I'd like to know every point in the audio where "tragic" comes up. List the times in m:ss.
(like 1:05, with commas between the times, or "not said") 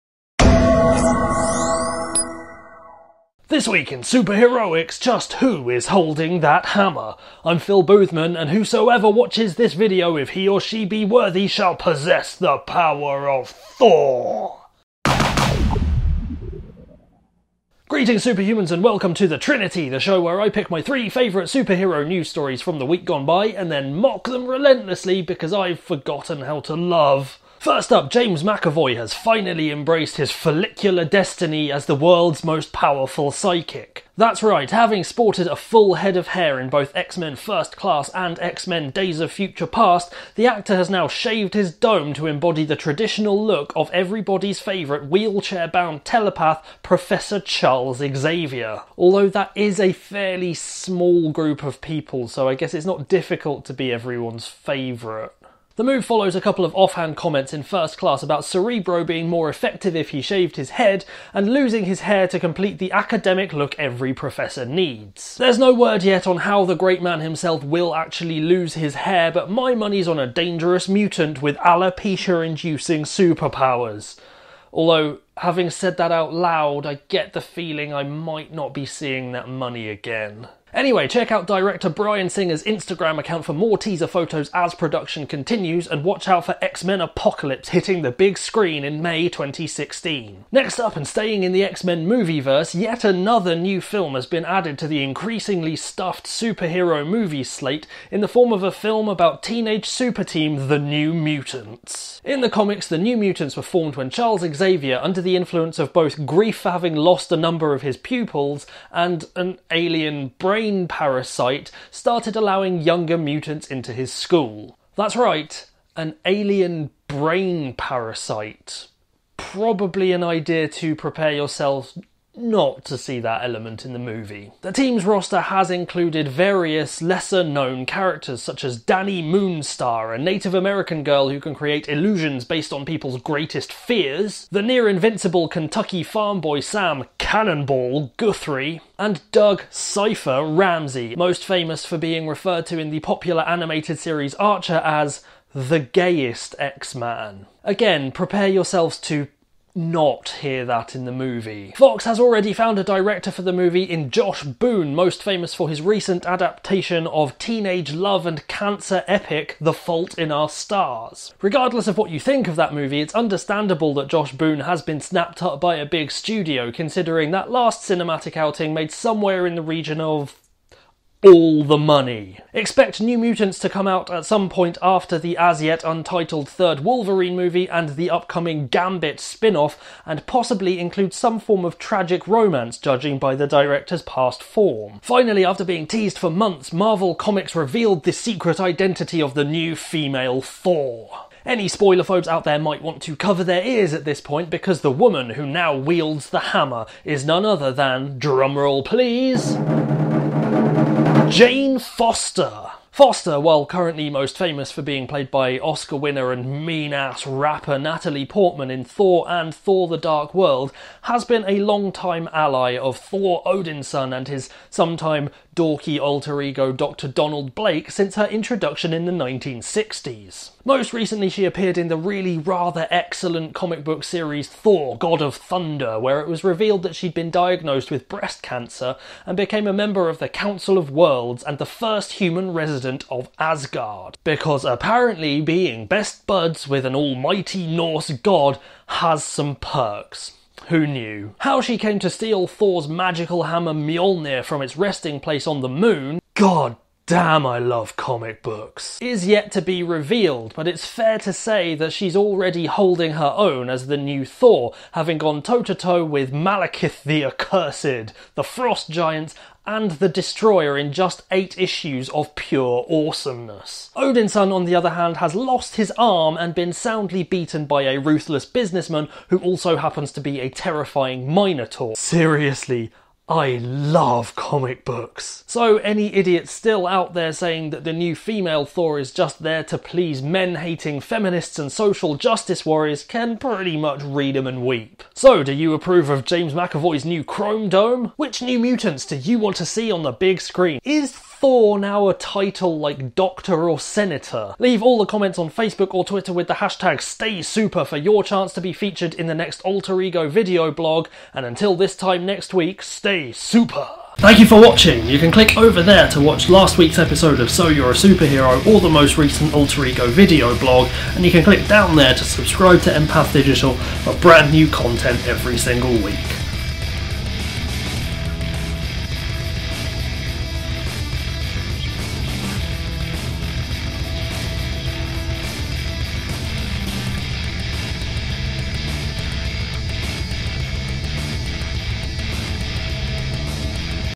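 3:01.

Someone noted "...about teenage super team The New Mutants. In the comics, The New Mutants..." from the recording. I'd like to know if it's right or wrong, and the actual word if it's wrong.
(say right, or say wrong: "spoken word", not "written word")
right.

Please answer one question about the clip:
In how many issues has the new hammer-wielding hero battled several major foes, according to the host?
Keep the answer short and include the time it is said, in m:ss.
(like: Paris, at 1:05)
8, at 4:21.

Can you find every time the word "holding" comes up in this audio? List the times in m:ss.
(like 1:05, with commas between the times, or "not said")
0:05, 4:12.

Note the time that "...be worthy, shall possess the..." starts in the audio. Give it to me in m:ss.
0:10.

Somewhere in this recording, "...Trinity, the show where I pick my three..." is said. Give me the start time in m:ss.
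0:19.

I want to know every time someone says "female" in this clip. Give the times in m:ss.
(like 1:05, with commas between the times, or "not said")
3:09, 4:38.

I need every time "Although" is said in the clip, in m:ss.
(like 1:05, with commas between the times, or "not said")
0:48, 1:14.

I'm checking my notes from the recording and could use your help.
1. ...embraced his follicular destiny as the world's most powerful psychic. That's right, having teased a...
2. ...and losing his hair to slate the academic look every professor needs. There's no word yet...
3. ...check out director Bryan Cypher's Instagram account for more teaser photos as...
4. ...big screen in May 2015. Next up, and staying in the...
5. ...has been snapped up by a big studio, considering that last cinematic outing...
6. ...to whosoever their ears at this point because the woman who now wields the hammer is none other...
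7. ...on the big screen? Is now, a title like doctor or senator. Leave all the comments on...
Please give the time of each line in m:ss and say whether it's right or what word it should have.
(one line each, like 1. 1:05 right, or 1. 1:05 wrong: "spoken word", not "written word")
1. 0:29 wrong: "sported", not "teased"
2. 1:01 wrong: "complete", not "slate"
3. 1:21 wrong: "Singer", not "Cypher"
4. 1:28 wrong: "2016", not "2015"
5. 2:44 right
6. 3:13 wrong: "cover", not "whosoever"
7. 4:49 right.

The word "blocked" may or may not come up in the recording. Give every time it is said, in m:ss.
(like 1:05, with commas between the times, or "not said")
not said.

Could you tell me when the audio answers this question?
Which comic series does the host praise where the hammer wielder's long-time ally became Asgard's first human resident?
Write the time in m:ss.
3:44.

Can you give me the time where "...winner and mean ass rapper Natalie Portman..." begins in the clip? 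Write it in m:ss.
3:25.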